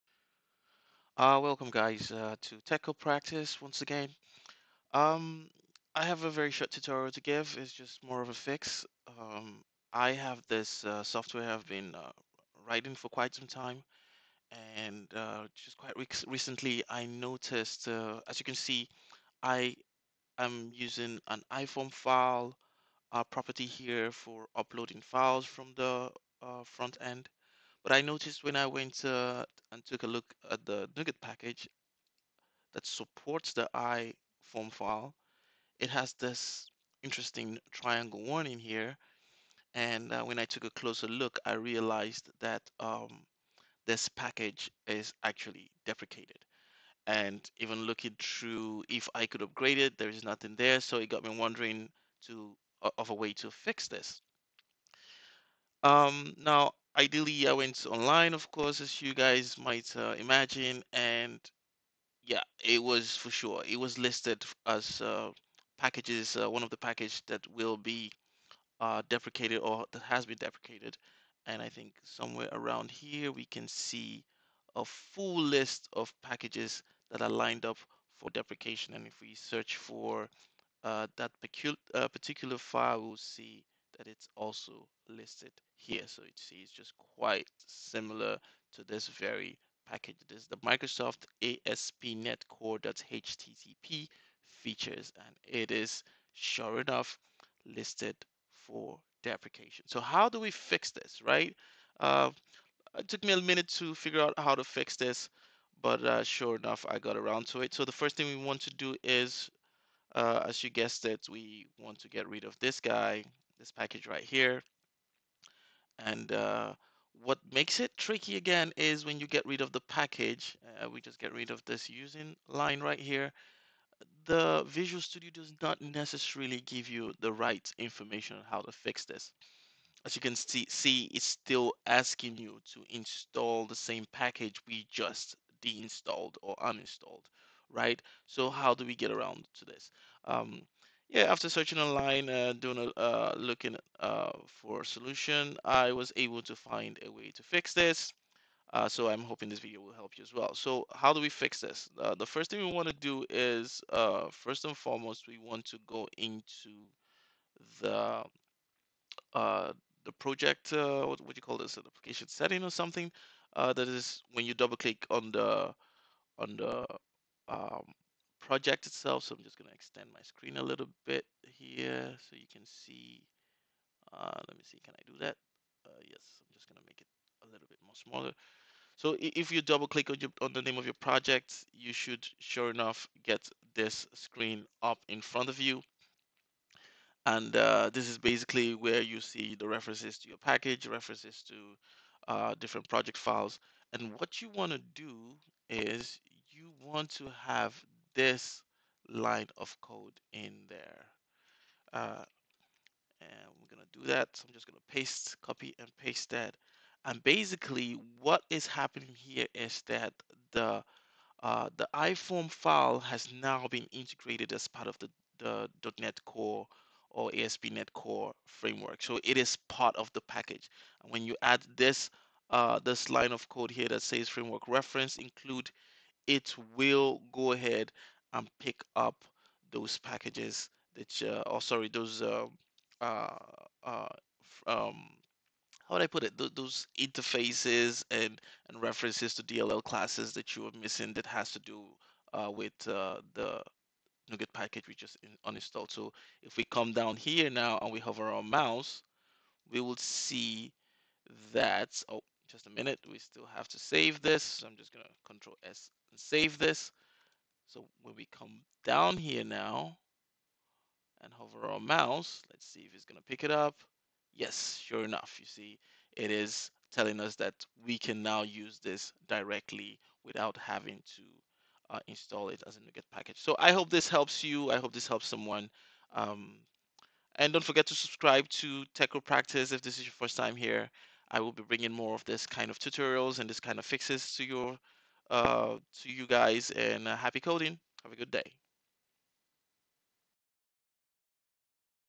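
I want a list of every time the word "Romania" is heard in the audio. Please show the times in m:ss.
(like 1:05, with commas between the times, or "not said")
not said.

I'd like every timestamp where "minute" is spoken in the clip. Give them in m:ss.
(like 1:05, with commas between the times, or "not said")
1:43, 4:12.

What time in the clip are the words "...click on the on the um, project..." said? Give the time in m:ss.
2:44.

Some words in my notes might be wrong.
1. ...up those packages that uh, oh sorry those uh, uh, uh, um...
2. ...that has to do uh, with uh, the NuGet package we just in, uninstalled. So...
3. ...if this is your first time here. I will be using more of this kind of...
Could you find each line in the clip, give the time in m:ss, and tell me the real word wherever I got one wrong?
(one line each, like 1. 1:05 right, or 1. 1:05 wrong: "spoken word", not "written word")
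1. 3:48 right
2. 4:01 right
3. 4:39 wrong: "bringing", not "using".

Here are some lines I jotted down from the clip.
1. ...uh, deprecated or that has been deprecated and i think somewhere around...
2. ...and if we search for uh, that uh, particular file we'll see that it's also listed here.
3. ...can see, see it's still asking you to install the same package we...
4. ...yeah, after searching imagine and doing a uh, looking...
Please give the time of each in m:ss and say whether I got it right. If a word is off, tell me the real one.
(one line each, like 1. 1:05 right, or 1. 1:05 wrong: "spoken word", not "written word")
1. 1:08 right
2. 1:18 right
3. 2:10 right
4. 2:21 wrong: "online", not "imagine".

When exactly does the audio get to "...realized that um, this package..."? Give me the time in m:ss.
0:41.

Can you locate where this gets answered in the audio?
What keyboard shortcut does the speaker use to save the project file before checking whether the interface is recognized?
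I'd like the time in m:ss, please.
4:15.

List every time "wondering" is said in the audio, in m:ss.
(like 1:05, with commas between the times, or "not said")
0:51.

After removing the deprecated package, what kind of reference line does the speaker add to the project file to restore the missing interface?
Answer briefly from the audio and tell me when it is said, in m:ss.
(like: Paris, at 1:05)
framework reference include, at 3:44.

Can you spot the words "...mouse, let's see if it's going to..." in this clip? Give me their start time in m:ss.
4:21.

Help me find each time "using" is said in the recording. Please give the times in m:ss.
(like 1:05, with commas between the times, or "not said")
0:20, 2:01.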